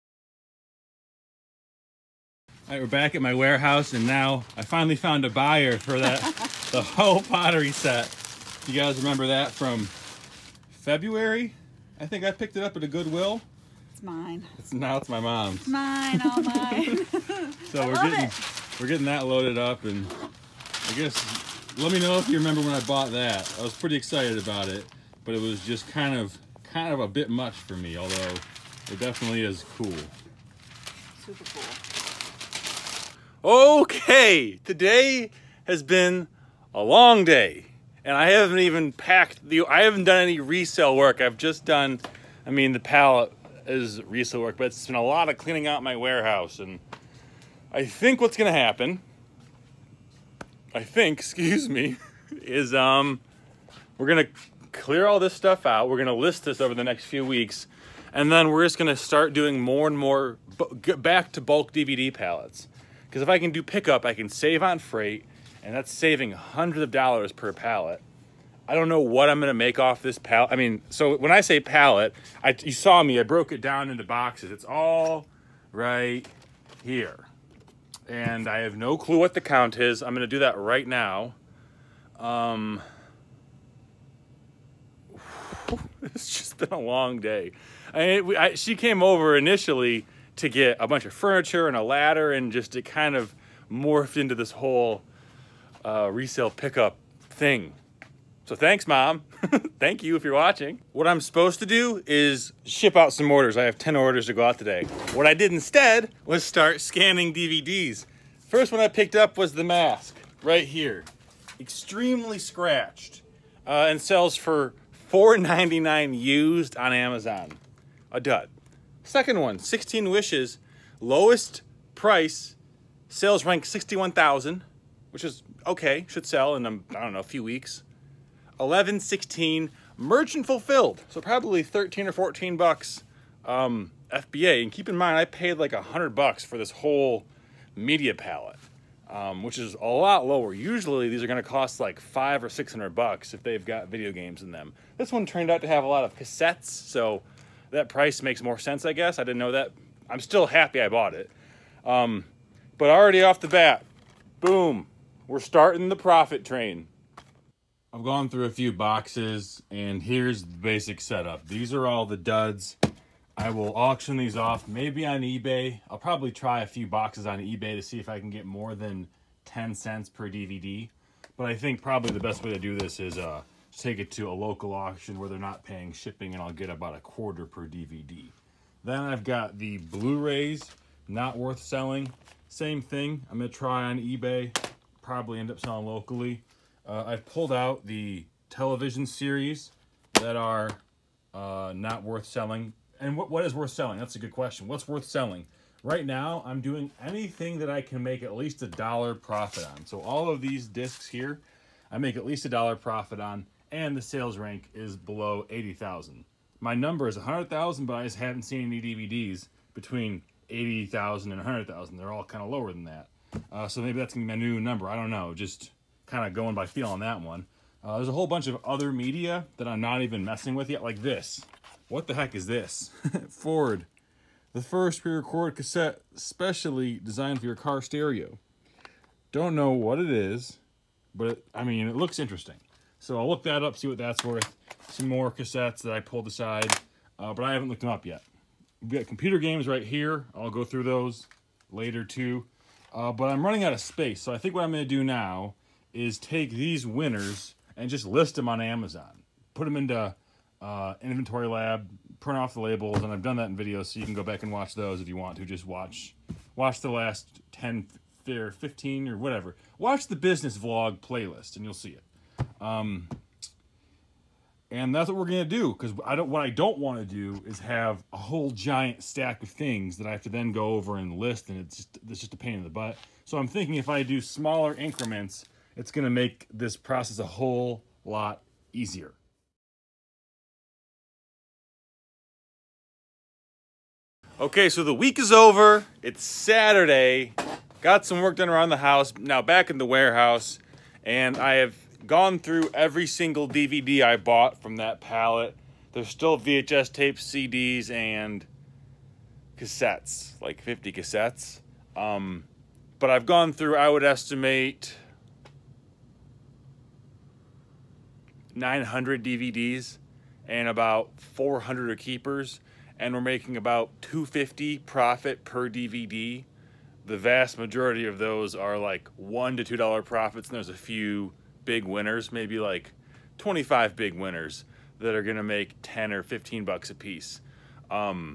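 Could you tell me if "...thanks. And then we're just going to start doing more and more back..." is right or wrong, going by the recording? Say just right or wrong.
wrong.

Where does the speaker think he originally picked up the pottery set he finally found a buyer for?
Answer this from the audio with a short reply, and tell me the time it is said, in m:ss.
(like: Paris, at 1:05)
Goodwill, at 0:12.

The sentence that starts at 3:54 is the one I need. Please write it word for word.
Some more cassettes that I pulled aside, uh, but I haven't looked them up yet.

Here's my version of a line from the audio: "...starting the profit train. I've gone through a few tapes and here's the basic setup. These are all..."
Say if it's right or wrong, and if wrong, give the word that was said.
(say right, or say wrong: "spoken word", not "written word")
wrong: "boxes", not "tapes".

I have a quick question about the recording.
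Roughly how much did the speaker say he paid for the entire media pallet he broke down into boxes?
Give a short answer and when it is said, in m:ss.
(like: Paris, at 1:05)
$100, at 2:15.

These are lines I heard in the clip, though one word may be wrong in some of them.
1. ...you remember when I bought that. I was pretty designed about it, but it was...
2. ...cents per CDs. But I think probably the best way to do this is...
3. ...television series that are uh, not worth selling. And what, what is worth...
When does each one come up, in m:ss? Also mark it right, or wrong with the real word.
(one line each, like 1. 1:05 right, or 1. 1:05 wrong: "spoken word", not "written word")
1. 0:22 wrong: "excited", not "designed"
2. 2:49 wrong: "DVD", not "CDs"
3. 3:08 right.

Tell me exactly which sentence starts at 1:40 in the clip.
What I'm supposed to do is ship out some orders.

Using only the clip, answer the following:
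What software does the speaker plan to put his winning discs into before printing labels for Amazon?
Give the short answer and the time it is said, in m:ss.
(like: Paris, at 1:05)
Inventory Lab, at 4:11.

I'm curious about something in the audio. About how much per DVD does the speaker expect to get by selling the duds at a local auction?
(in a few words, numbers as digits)
a quarter.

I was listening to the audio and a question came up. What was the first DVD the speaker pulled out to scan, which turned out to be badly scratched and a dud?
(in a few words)
The Mask.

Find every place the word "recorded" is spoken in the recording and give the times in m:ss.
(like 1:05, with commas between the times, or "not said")
3:45.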